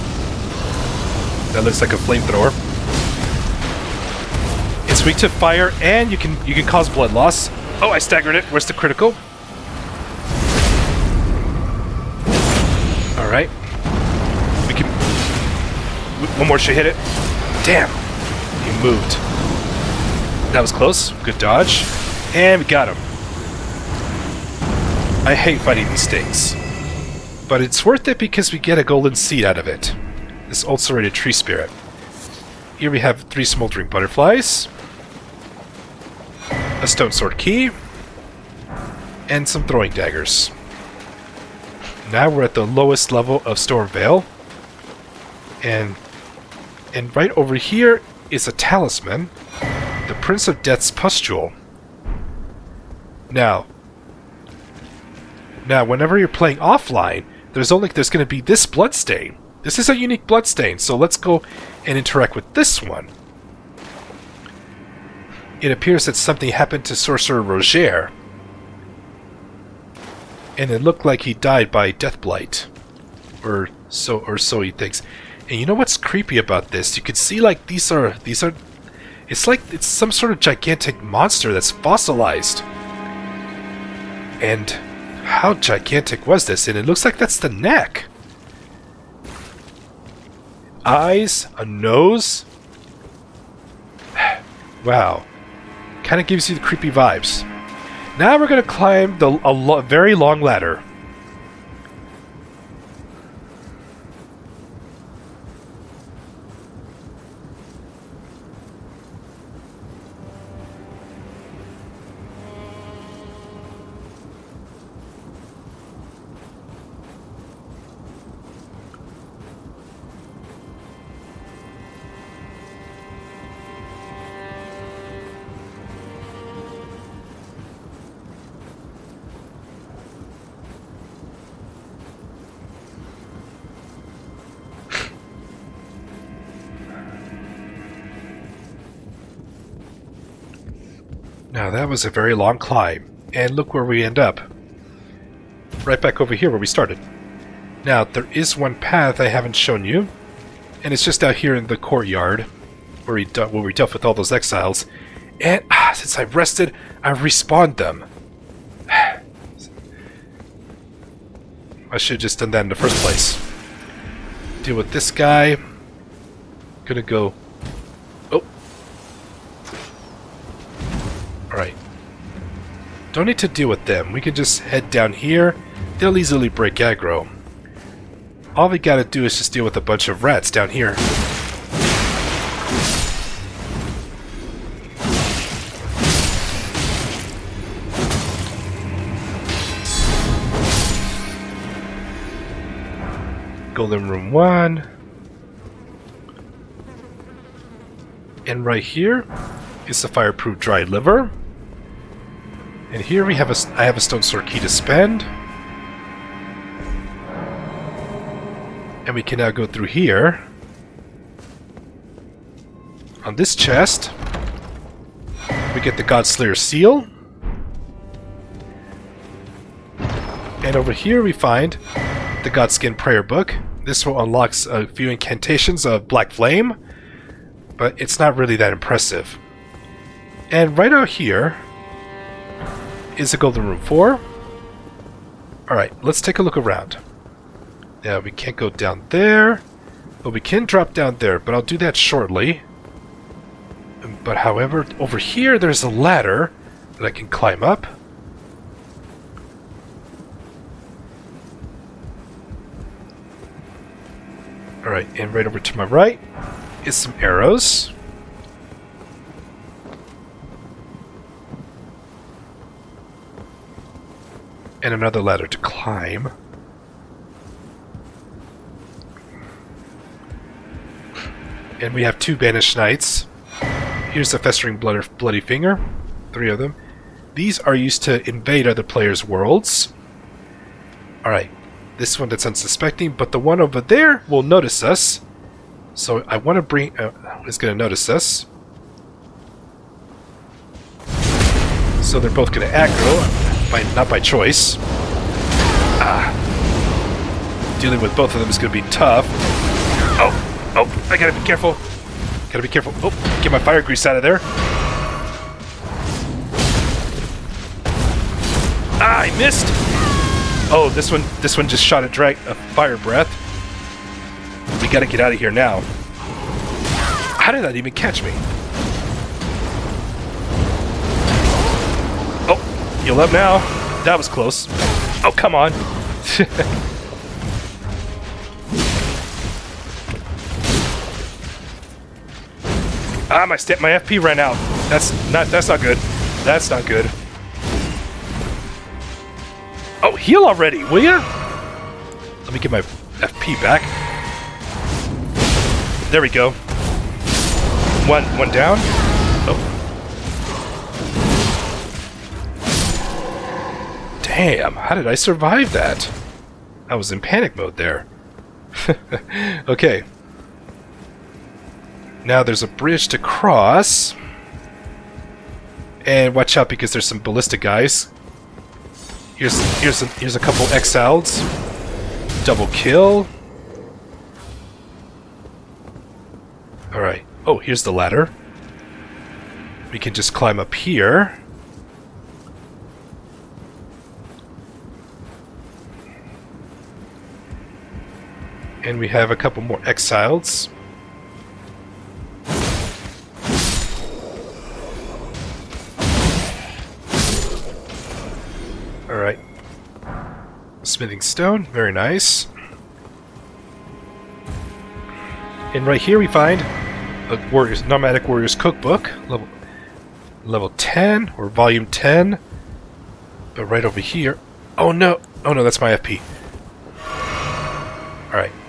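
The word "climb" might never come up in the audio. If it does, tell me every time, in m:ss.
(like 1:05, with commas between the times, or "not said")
1:38, 2:22, 4:07, 4:25, 6:20.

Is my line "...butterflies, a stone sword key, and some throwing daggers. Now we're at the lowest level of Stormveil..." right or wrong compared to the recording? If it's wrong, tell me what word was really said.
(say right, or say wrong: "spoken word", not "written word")
right.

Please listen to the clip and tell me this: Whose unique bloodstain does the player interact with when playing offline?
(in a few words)
Sorcerer Rogier.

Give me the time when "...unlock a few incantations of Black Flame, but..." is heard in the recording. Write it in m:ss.
3:44.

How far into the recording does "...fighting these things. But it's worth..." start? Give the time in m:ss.
0:25.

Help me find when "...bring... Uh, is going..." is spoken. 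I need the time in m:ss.
4:46.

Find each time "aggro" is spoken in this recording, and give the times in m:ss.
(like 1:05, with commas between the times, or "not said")
2:56, 4:52.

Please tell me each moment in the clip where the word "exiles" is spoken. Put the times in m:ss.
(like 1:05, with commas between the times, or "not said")
2:34, 6:10, 6:29.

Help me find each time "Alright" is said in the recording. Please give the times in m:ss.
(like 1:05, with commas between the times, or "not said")
3:55, 4:14, 4:41, 6:39.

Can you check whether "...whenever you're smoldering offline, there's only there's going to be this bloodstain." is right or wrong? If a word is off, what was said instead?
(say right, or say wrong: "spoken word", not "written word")
wrong: "playing", not "smoldering".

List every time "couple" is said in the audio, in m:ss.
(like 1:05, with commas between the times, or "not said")
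6:10, 6:29.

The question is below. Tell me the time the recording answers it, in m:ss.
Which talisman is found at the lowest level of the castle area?
0:50.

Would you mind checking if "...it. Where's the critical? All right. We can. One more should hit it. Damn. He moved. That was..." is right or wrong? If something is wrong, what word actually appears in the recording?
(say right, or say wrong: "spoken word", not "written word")
right.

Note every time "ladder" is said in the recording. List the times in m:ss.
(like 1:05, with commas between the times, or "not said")
1:40, 4:05, 4:25, 6:17.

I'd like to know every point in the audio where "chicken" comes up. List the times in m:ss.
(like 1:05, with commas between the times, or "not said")
not said.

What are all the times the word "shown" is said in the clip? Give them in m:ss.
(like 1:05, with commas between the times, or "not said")
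2:29.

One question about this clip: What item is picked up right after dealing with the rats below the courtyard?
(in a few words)
Fireproof dry liver.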